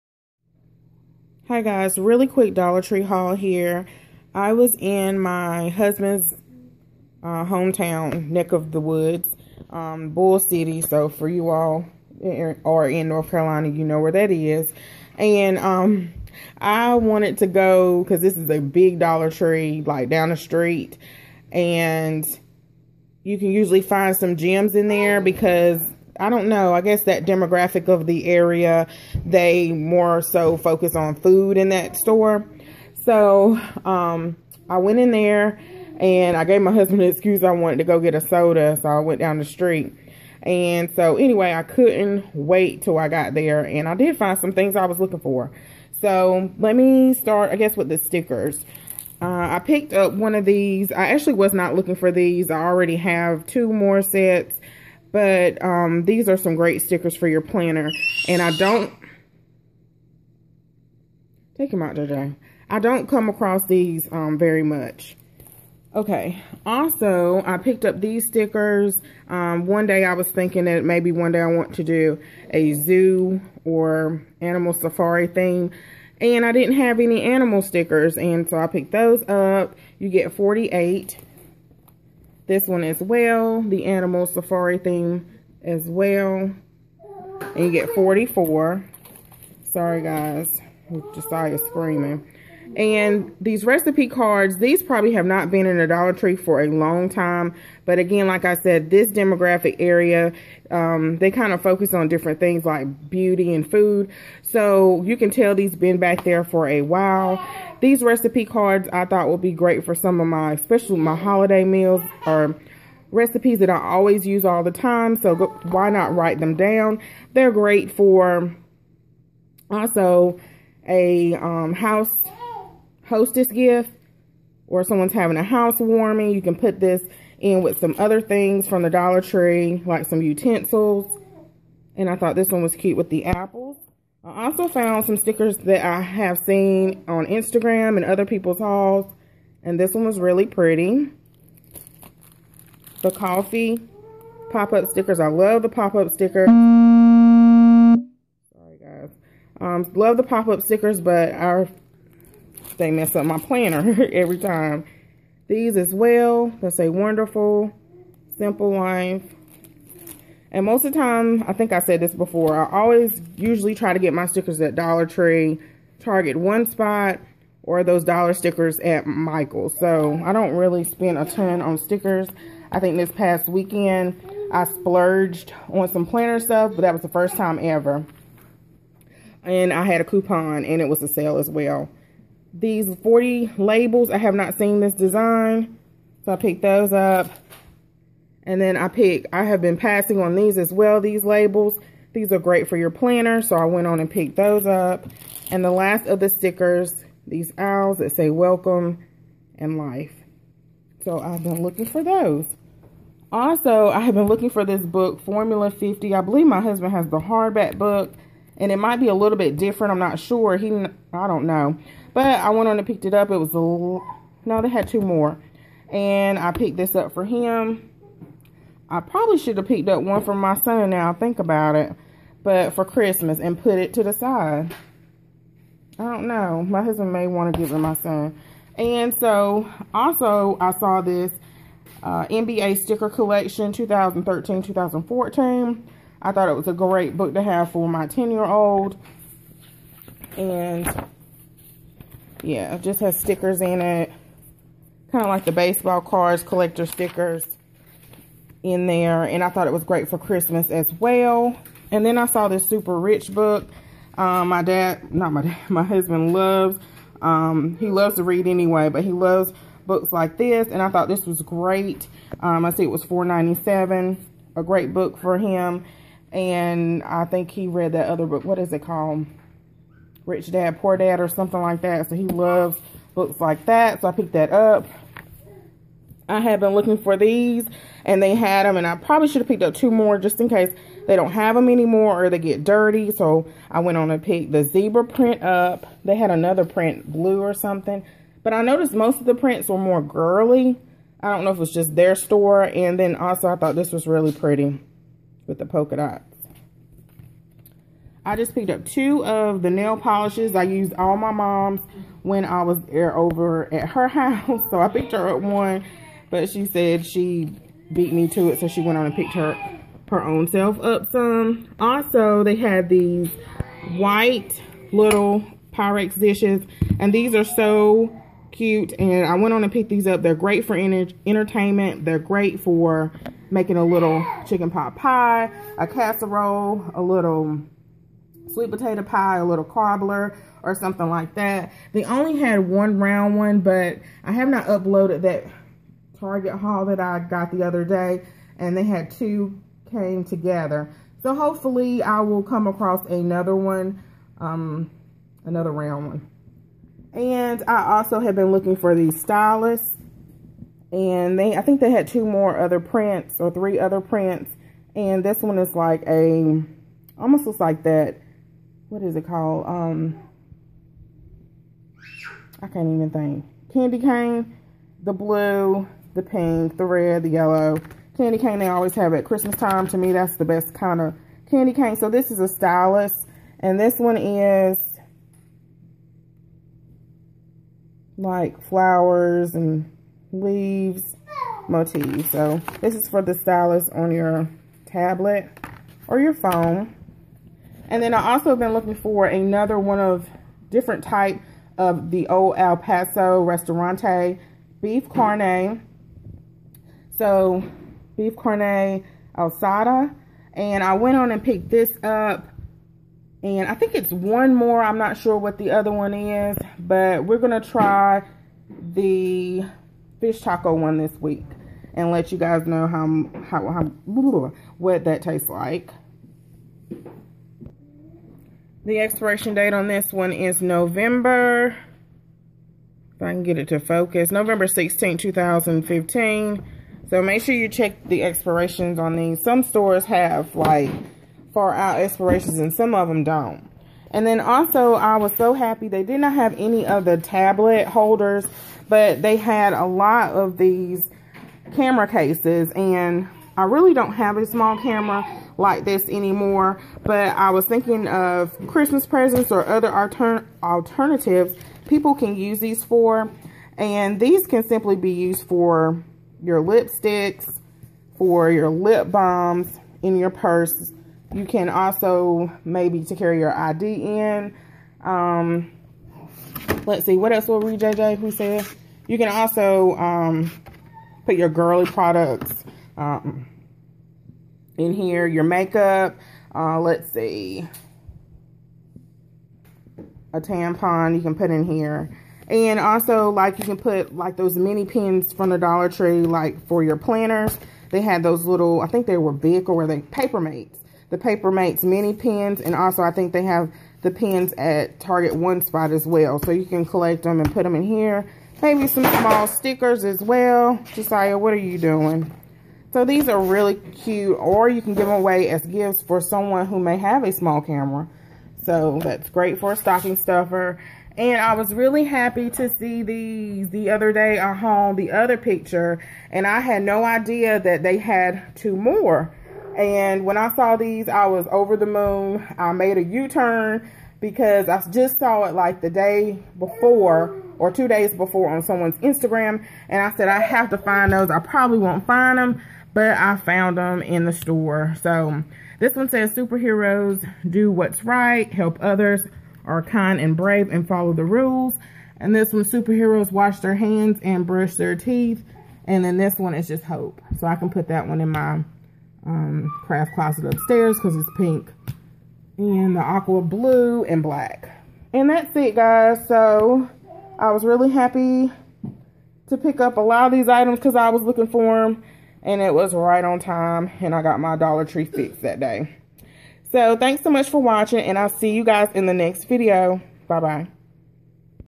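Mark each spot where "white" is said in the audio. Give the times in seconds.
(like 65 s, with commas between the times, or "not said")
313 s.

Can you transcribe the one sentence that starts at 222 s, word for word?
But for Christmas and put it to the side.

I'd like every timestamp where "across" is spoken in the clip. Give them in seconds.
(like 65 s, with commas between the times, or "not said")
63 s, 342 s.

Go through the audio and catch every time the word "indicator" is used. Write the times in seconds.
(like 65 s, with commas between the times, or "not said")
not said.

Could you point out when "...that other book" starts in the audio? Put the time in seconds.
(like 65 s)
267 s.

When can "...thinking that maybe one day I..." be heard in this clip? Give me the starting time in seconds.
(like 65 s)
70 s.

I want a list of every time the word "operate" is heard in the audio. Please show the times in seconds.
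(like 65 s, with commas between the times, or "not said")
not said.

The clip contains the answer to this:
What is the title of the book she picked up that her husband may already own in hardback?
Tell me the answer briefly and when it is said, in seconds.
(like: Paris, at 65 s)
Formula 50, at 205 s.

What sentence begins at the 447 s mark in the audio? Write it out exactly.
But I was thinking of Christmas presents or other alternatives people can use these for.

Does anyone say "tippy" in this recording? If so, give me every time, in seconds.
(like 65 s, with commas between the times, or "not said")
not said.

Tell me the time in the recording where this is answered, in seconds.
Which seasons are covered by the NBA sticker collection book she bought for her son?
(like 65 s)
233 s.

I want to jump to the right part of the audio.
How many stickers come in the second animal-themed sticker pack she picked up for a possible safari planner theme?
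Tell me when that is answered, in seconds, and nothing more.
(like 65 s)
87 s.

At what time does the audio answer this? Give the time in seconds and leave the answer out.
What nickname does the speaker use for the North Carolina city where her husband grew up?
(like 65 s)
10 s.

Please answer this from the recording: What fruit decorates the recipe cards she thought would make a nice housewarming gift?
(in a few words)
apples.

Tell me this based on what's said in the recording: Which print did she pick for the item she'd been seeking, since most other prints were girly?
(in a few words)
zebra print.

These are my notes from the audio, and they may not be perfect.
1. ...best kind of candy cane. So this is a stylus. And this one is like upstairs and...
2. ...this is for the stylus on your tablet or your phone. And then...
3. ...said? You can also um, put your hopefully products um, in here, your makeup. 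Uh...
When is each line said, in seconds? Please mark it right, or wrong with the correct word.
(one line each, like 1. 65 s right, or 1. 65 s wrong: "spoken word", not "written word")
1. 370 s wrong: "flowers", not "upstairs"
2. 382 s right
3. 468 s wrong: "girly", not "hopefully".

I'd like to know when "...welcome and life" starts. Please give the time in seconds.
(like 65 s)
198 s.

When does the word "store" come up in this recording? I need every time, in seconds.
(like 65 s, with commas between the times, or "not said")
31 s, 292 s, 429 s, 534 s.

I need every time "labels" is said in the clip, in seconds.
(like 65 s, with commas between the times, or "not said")
183 s, 191 s.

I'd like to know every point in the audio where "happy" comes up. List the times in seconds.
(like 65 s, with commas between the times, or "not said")
435 s, 512 s, 557 s.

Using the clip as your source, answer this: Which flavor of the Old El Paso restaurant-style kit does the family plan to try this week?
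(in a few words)
fish taco.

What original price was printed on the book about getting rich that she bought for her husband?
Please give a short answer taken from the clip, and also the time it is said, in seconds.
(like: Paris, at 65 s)
$4.97, at 263 s.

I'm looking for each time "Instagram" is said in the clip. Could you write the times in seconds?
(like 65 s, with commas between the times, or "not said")
137 s, 528 s.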